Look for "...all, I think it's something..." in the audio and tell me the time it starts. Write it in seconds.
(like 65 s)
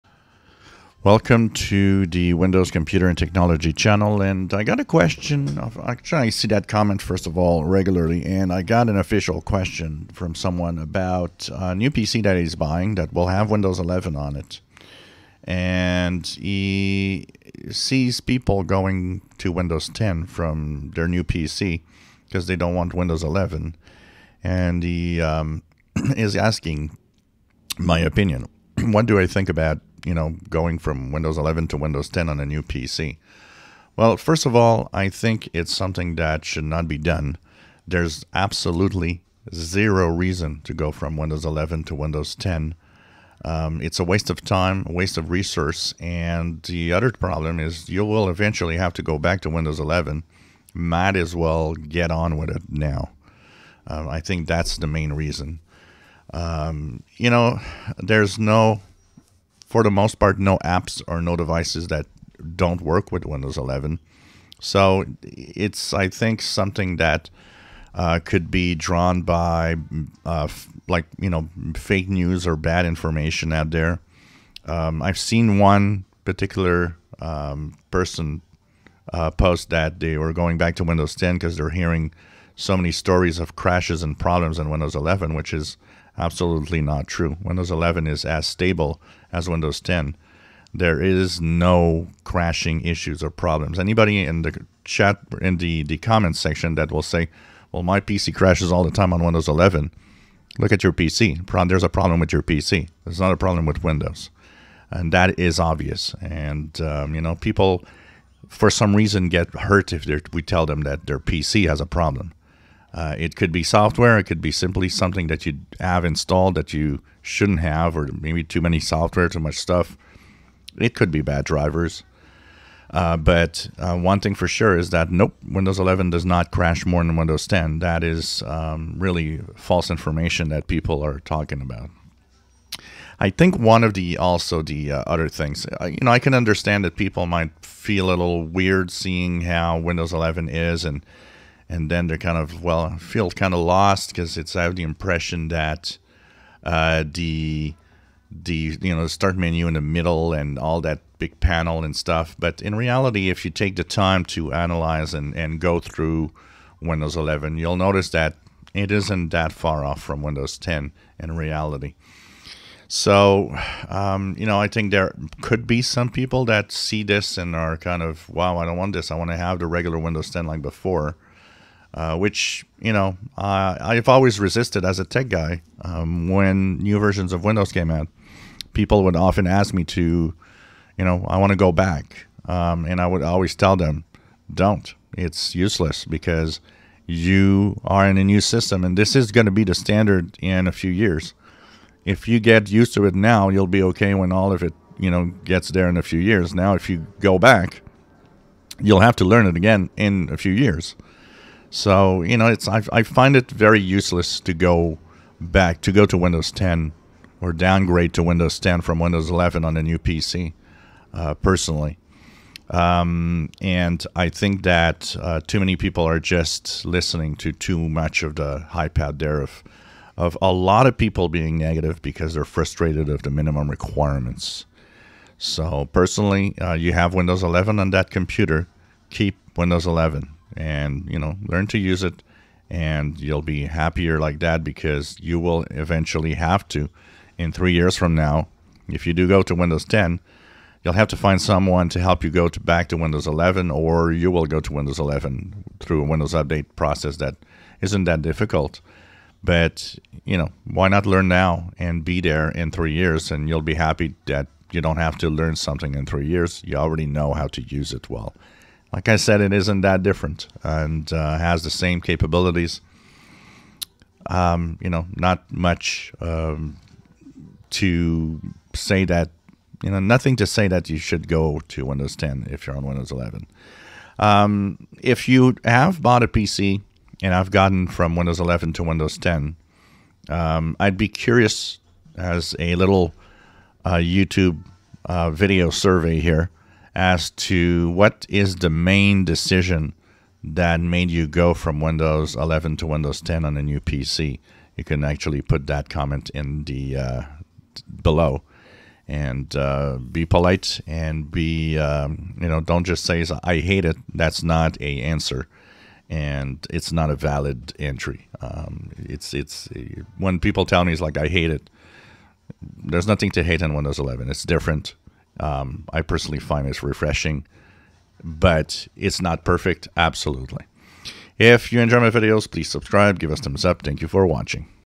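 34 s.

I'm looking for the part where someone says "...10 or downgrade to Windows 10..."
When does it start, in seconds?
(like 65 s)
206 s.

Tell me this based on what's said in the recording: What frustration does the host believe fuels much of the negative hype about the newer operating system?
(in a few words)
minimum requirements.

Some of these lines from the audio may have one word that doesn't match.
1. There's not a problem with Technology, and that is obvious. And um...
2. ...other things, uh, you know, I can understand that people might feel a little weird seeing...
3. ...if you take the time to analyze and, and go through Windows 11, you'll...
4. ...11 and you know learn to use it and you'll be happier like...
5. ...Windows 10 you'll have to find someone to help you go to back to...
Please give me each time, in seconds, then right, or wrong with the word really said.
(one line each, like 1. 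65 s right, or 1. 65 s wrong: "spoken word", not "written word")
1. 103 s wrong: "Windows", not "Technology"
2. 135 s right
3. 153 s right
4. 229 s right
5. 239 s right.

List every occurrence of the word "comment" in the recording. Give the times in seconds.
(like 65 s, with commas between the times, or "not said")
6 s, 95 s, 295 s.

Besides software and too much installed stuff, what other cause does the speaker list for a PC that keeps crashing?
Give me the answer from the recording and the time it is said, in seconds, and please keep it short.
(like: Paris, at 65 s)
bad drivers, at 121 s.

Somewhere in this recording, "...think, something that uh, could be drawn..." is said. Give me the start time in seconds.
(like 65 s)
66 s.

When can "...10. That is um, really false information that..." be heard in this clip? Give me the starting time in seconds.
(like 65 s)
127 s.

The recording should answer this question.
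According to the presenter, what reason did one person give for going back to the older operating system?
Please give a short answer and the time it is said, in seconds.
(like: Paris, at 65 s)
crashes and problems, at 83 s.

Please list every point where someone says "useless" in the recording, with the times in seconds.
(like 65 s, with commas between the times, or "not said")
185 s, 203 s.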